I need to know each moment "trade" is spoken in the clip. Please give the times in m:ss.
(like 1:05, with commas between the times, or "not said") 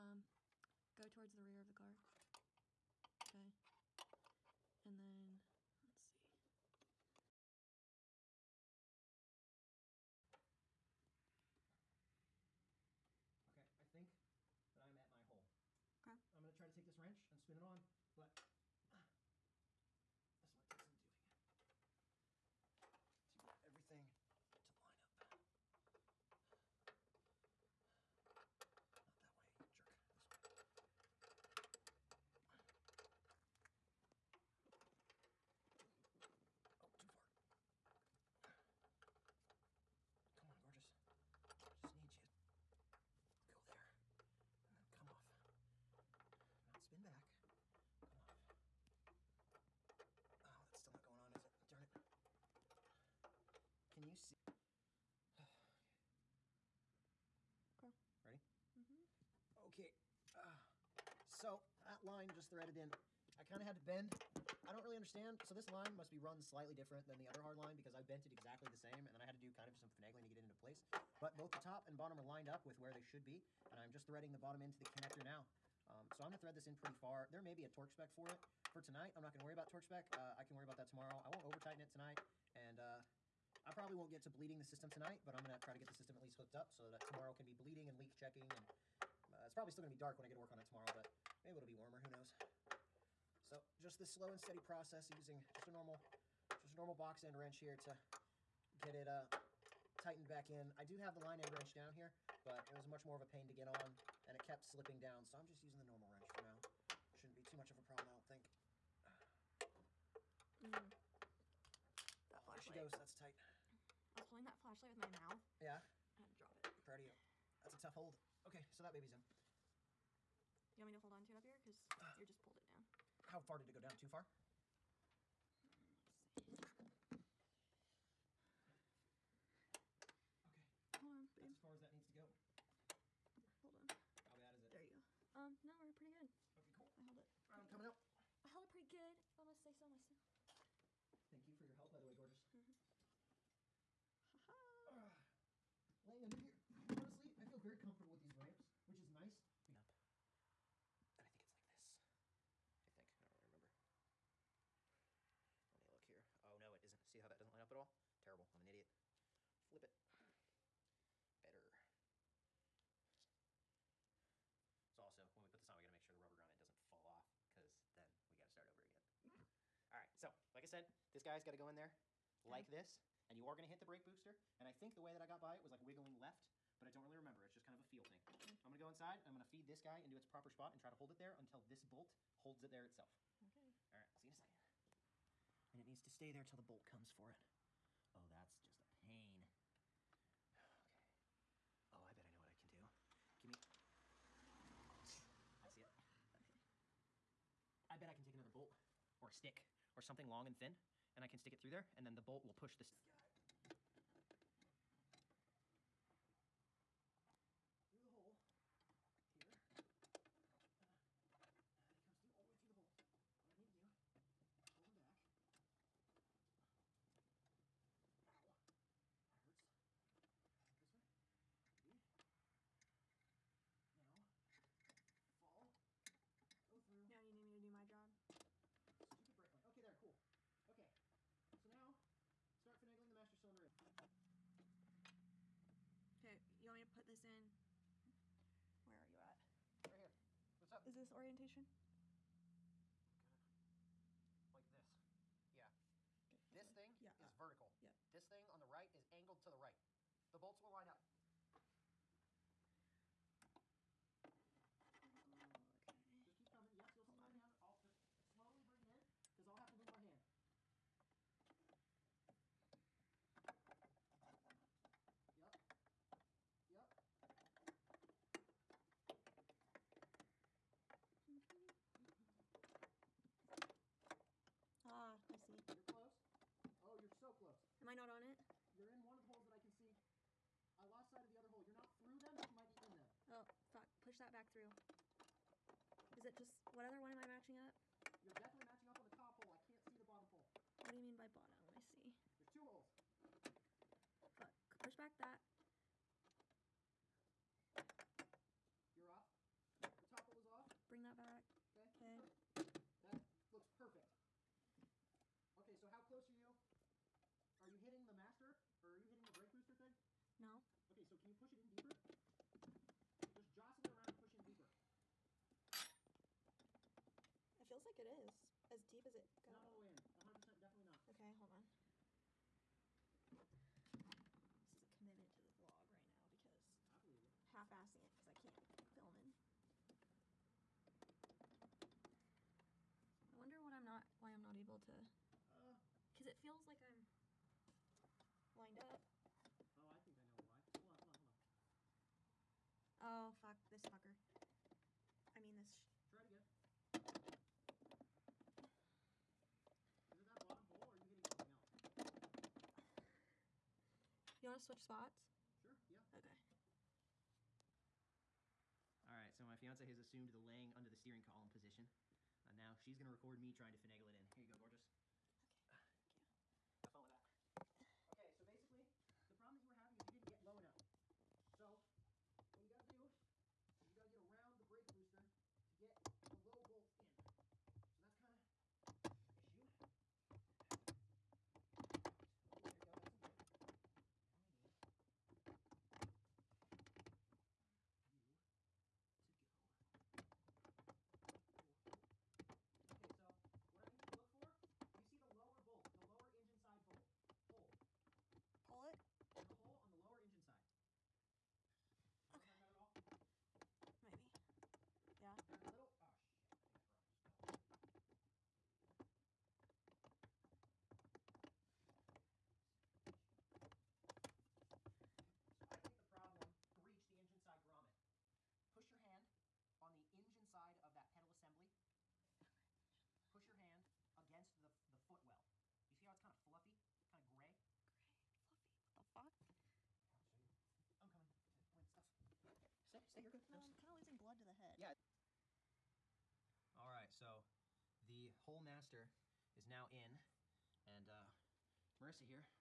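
not said.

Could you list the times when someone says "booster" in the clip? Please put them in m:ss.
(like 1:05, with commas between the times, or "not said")
2:54, 5:09, 6:14.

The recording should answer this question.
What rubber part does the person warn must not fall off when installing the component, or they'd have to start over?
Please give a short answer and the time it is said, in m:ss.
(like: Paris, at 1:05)
rubber grommet, at 2:46.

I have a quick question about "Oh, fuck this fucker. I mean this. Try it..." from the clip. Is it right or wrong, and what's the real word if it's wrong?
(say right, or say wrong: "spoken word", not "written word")
right.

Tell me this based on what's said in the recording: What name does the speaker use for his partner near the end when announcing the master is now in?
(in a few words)
Marissa.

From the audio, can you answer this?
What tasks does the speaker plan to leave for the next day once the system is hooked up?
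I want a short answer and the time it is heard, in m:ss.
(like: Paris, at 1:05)
bleeding and leak checking, at 1:27.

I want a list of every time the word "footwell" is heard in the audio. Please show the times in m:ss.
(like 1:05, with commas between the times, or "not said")
7:05.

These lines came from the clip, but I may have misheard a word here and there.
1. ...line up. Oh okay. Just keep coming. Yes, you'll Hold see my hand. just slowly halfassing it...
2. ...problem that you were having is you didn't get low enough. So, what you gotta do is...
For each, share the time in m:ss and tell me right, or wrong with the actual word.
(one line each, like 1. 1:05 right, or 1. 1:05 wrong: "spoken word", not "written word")
1. 4:10 wrong: "bring", not "halfassing"
2. 6:09 right.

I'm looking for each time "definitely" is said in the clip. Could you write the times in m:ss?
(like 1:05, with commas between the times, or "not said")
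4:48, 5:20.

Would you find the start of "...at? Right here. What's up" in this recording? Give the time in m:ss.
3:59.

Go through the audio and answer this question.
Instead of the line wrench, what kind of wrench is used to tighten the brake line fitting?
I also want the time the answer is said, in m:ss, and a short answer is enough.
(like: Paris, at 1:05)
box end wrench, at 1:36.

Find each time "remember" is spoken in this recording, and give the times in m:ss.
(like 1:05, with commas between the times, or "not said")
2:33, 2:57.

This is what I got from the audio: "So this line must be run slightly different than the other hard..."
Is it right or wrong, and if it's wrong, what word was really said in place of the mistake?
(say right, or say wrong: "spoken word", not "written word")
right.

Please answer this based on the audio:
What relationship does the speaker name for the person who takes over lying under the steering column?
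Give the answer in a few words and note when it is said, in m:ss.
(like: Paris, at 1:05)
fiance, at 5:59.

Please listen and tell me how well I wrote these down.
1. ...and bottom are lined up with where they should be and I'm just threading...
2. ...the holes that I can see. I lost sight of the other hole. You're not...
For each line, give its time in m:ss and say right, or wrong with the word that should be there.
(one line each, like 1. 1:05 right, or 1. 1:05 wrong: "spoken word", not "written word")
1. 1:11 right
2. 4:39 right.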